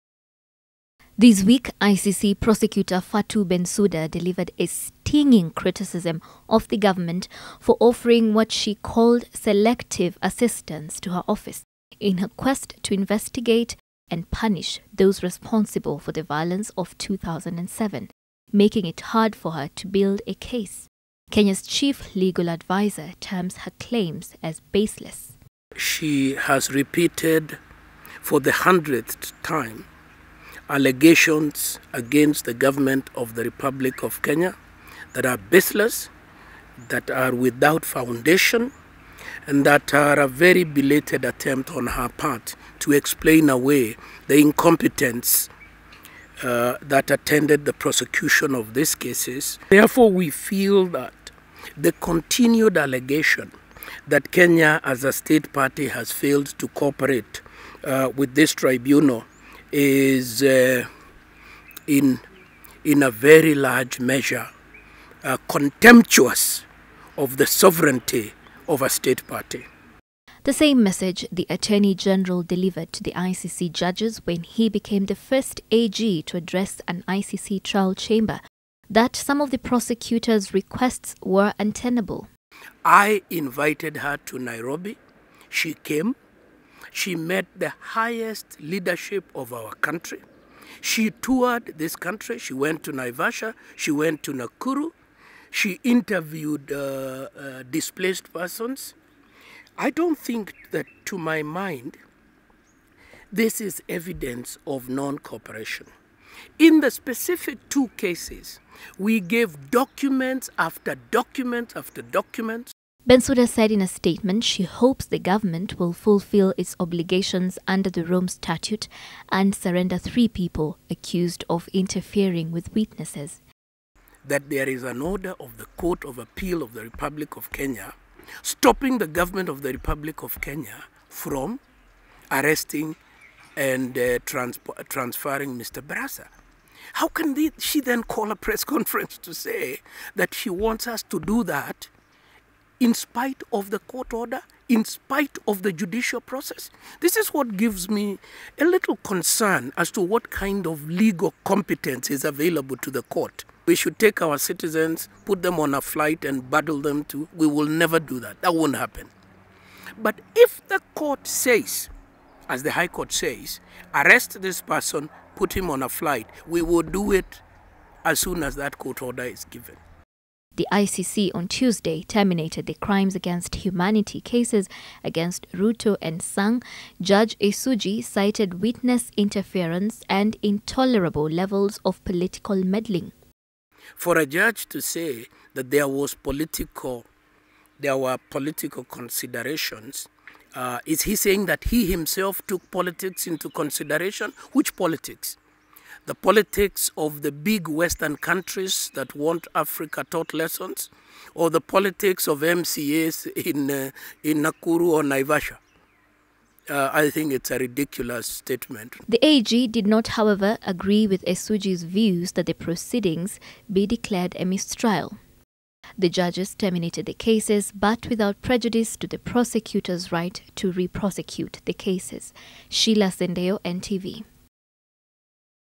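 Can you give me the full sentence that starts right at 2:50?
The ICC on Tuesday terminated the crimes against humanity cases against Ruto and Sang.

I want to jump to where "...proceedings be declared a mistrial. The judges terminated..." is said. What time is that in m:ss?
3:32.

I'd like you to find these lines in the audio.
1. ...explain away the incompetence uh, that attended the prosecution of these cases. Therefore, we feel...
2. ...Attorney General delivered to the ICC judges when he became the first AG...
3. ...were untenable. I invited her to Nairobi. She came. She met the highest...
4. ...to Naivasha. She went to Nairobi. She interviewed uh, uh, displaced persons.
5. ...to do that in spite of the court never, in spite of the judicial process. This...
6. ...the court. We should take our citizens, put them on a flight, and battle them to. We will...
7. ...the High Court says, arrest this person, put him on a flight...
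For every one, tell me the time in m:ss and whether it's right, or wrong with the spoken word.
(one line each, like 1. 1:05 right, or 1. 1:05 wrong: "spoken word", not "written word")
1. 0:42 right
2. 1:11 right
3. 1:21 right
4. 1:32 wrong: "Nakuru", not "Nairobi"
5. 2:21 wrong: "order", not "never"
6. 2:32 right
7. 2:42 right.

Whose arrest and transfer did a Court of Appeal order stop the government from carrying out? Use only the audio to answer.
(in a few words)
Mr. Barasa.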